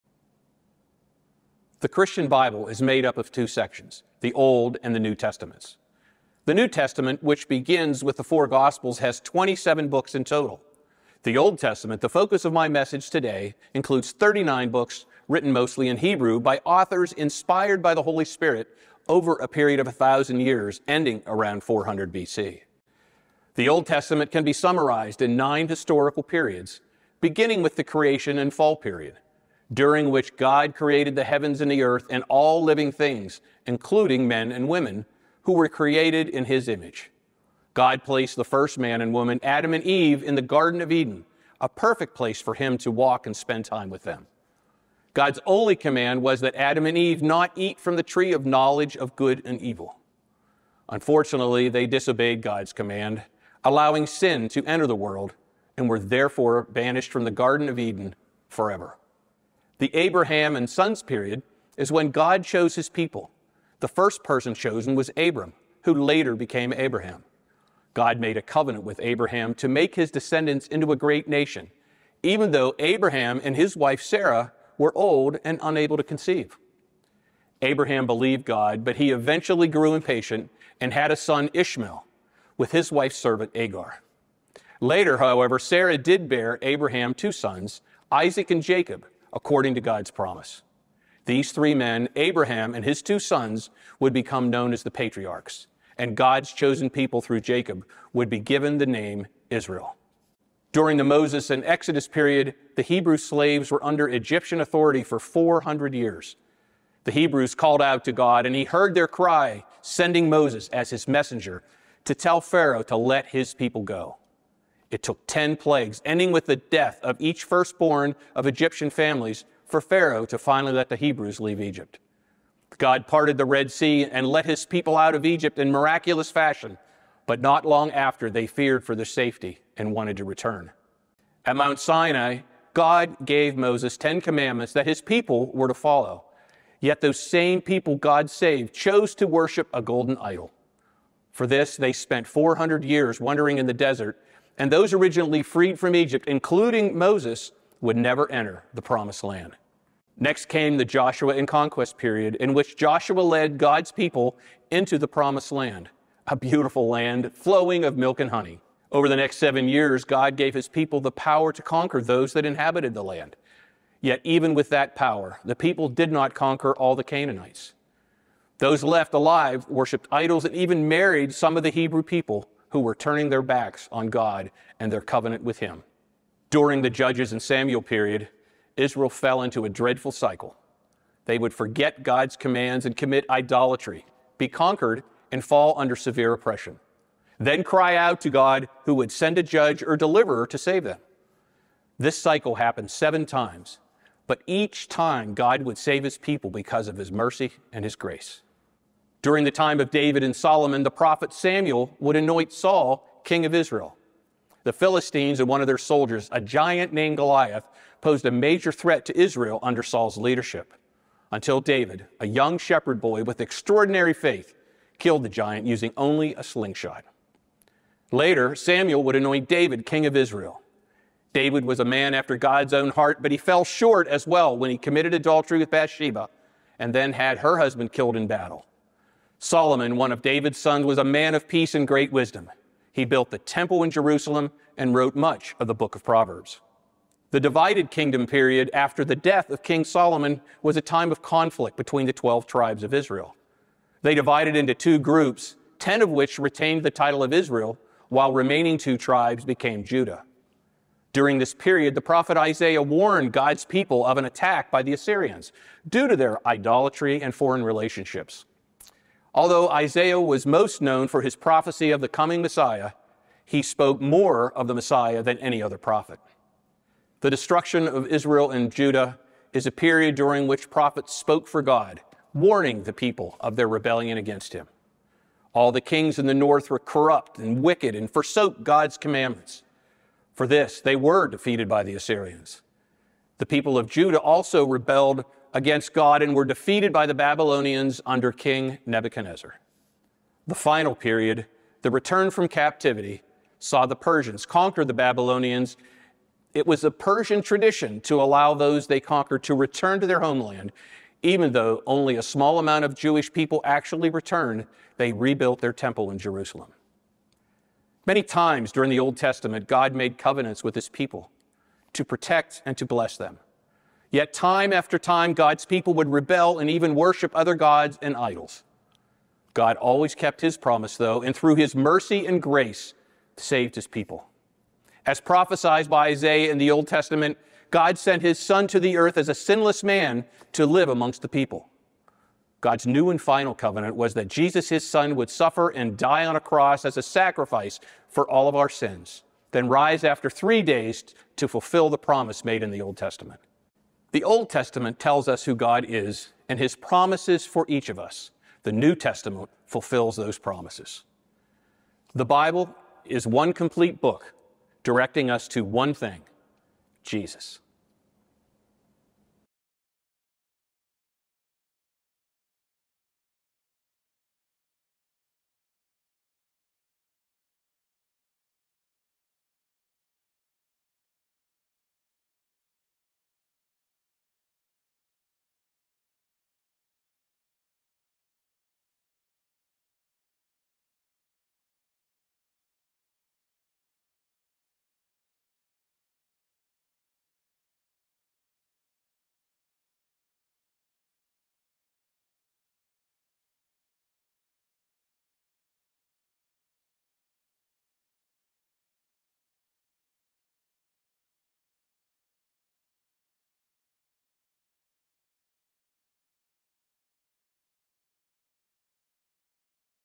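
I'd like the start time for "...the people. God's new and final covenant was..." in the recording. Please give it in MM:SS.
05:31.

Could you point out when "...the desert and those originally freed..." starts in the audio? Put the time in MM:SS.
02:23.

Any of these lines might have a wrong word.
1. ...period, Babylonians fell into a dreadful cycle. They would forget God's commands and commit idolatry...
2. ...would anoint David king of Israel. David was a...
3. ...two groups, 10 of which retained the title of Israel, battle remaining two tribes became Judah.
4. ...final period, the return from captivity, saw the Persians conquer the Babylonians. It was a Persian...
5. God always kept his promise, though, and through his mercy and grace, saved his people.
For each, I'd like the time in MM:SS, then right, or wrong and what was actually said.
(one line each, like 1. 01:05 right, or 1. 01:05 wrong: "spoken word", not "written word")
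1. 02:57 wrong: "Israel", not "Babylonians"
2. 03:39 right
3. 04:04 wrong: "while", not "battle"
4. 04:50 right
5. 05:19 right.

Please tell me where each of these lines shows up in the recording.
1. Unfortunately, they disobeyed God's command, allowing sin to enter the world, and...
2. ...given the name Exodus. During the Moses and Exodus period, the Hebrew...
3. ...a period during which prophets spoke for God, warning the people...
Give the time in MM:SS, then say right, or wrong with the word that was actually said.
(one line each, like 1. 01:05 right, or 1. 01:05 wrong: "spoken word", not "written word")
1. 00:50 right
2. 01:38 wrong: "Israel", not "Exodus"
3. 04:29 right.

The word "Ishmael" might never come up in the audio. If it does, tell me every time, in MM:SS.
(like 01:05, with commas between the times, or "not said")
01:21.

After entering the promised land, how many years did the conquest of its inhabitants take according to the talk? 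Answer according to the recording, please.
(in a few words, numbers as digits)
7.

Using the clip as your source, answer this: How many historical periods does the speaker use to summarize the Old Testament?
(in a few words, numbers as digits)
9.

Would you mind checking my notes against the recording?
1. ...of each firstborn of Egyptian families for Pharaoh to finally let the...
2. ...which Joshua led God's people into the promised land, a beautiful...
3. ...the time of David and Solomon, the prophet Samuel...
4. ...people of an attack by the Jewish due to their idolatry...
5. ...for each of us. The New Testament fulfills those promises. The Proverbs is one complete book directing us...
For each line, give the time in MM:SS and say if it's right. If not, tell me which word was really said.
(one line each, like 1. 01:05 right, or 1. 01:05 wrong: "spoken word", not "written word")
1. 01:57 right
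2. 02:32 right
3. 03:19 right
4. 04:13 wrong: "Assyrians", not "Jewish"
5. 05:47 wrong: "Bible", not "Proverbs".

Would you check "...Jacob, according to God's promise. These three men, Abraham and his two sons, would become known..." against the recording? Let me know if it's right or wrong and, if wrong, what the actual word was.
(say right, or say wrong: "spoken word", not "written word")
right.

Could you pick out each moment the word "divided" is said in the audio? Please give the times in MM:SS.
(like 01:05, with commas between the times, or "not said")
03:57, 04:04.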